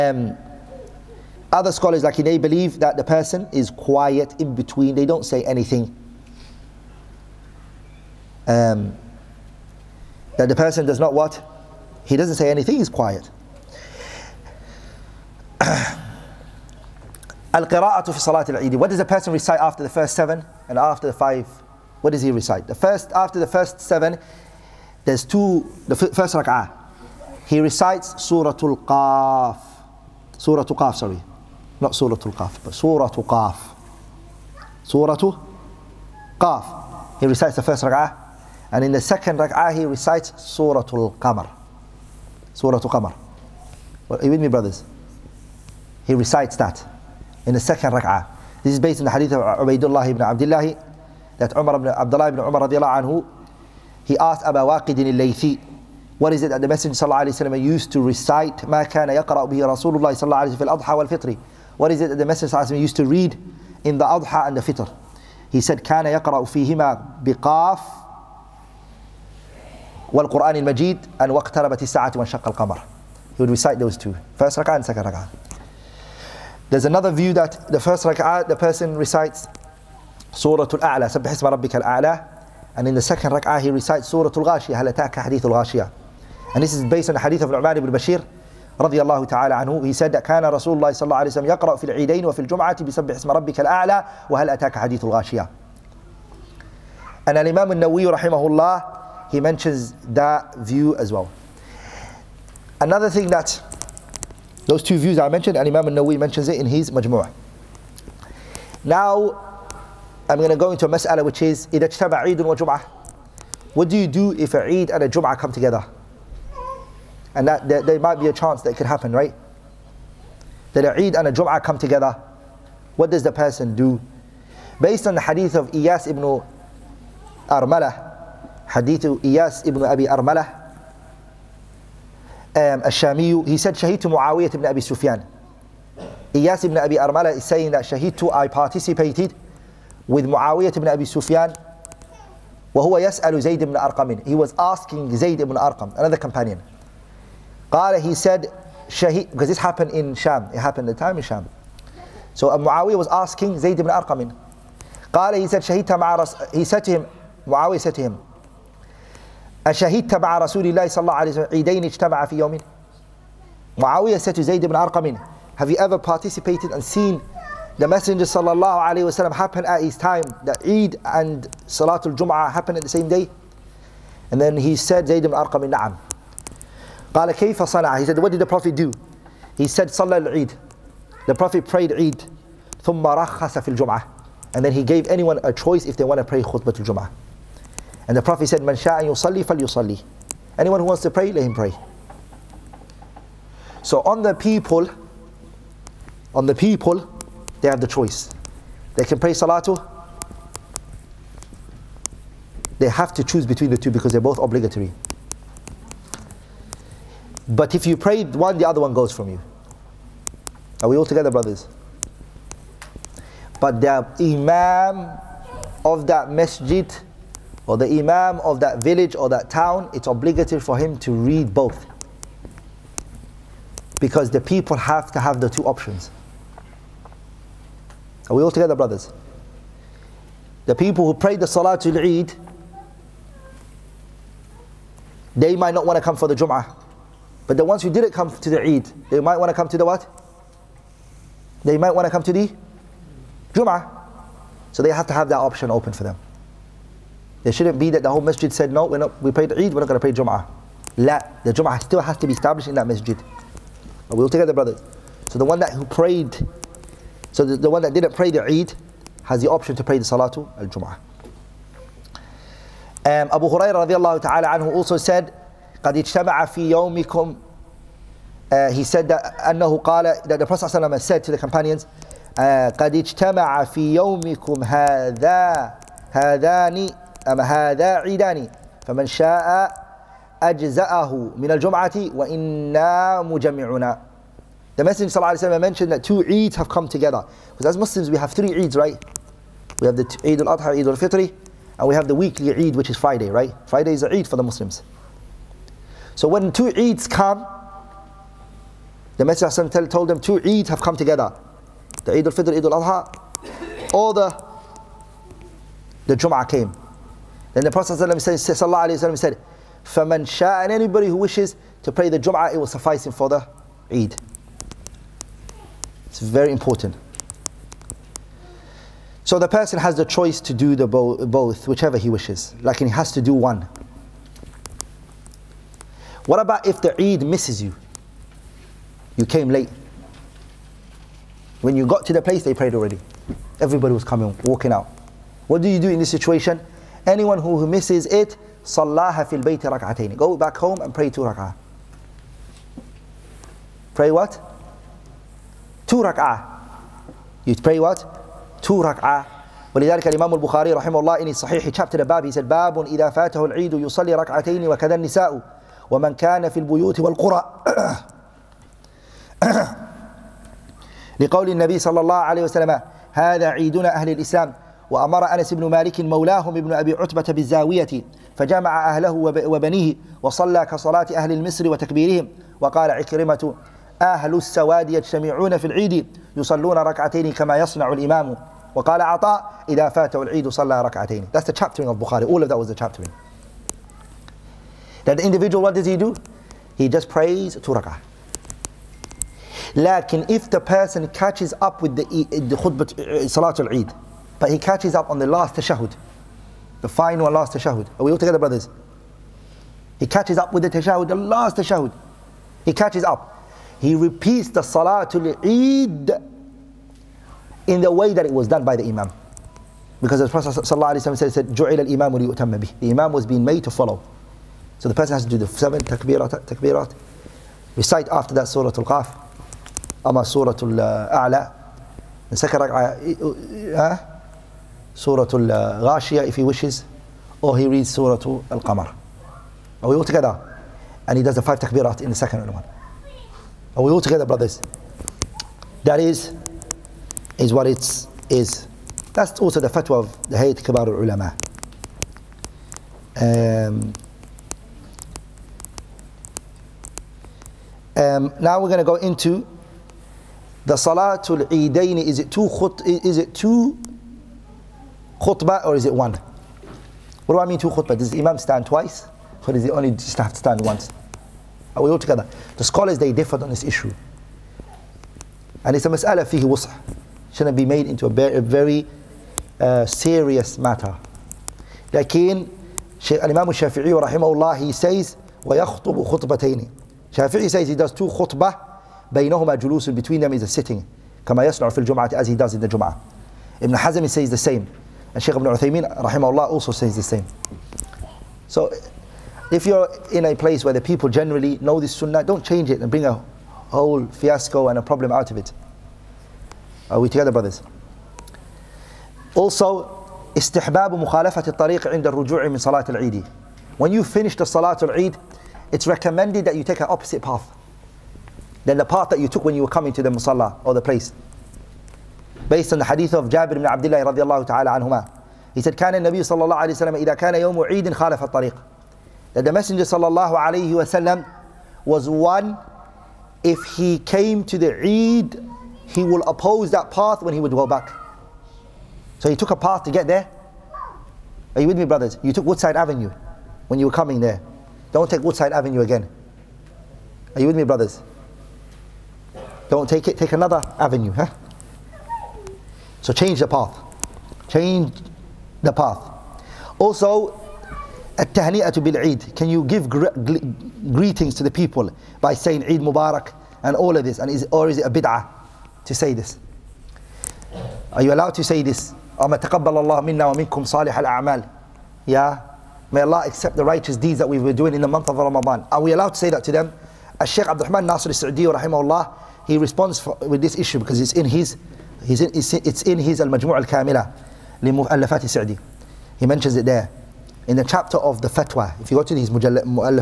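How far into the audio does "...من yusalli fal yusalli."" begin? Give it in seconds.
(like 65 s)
188 s.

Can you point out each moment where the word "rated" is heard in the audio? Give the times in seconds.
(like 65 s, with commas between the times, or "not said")
not said.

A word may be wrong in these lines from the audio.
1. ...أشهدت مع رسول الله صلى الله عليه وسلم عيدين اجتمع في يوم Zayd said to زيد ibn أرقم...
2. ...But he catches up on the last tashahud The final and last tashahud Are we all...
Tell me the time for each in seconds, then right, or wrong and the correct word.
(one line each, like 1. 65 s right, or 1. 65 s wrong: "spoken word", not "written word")
1. 159 s wrong: "Muawiyah", not "Zayd"
2. 394 s right.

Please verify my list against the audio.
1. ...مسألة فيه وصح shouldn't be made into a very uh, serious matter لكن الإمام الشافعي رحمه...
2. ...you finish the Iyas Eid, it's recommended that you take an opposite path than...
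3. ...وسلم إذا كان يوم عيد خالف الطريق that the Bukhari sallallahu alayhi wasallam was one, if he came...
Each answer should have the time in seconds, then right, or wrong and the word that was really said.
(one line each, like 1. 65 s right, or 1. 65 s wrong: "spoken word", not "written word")
1. 465 s right
2. 503 s wrong: "Salatul", not "Iyas"
3. 516 s wrong: "Messenger", not "Bukhari".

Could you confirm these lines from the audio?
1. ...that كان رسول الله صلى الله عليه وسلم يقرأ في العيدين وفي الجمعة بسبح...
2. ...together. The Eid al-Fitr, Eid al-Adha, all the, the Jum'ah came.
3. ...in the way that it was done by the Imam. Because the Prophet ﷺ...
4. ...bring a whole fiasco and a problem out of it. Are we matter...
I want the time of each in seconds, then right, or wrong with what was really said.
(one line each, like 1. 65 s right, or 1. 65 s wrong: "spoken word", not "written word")
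1. 90 s right
2. 300 s right
3. 407 s right
4. 492 s wrong: "together", not "matter".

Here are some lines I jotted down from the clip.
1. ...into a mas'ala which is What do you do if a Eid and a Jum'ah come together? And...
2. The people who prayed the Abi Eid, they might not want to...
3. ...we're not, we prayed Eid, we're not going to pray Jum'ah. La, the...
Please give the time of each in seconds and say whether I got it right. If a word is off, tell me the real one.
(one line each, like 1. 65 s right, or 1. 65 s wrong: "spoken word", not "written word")
1. 110 s right
2. 230 s wrong: "Salatul", not "Abi"
3. 248 s right.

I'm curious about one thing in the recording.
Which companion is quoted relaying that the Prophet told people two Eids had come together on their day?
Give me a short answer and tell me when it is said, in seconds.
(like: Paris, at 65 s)
Abu Hurairah, at 263 s.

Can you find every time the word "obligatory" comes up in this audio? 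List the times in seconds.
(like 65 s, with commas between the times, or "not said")
204 s, 220 s.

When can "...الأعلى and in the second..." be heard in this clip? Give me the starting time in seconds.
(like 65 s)
81 s.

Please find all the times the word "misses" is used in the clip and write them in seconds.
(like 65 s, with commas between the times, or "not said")
327 s, 337 s.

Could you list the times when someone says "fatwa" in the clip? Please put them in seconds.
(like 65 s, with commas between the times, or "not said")
439 s, 578 s.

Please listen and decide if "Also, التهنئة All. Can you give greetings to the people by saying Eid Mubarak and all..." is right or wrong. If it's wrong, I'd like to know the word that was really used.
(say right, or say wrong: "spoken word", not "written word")
wrong: "Eid", not "All".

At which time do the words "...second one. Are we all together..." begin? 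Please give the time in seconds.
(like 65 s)
432 s.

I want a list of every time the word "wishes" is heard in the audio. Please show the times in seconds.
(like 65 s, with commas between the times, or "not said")
311 s, 322 s, 426 s.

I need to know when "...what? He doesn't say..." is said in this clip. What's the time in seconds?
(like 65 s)
11 s.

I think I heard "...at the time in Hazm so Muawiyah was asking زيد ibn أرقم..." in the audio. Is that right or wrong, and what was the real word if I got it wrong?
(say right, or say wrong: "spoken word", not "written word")
wrong: "Sham", not "Hazm".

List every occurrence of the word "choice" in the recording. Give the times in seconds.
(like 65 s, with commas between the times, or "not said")
185 s, 197 s, 320 s.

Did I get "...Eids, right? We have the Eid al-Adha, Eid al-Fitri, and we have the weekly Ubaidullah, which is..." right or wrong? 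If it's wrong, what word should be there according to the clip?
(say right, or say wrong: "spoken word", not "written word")
wrong: "Eid", not "Ubaidullah".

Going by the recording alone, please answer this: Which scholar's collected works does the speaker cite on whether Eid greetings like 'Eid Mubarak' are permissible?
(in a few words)
Abdul Rahman Nasir al-Sa'di.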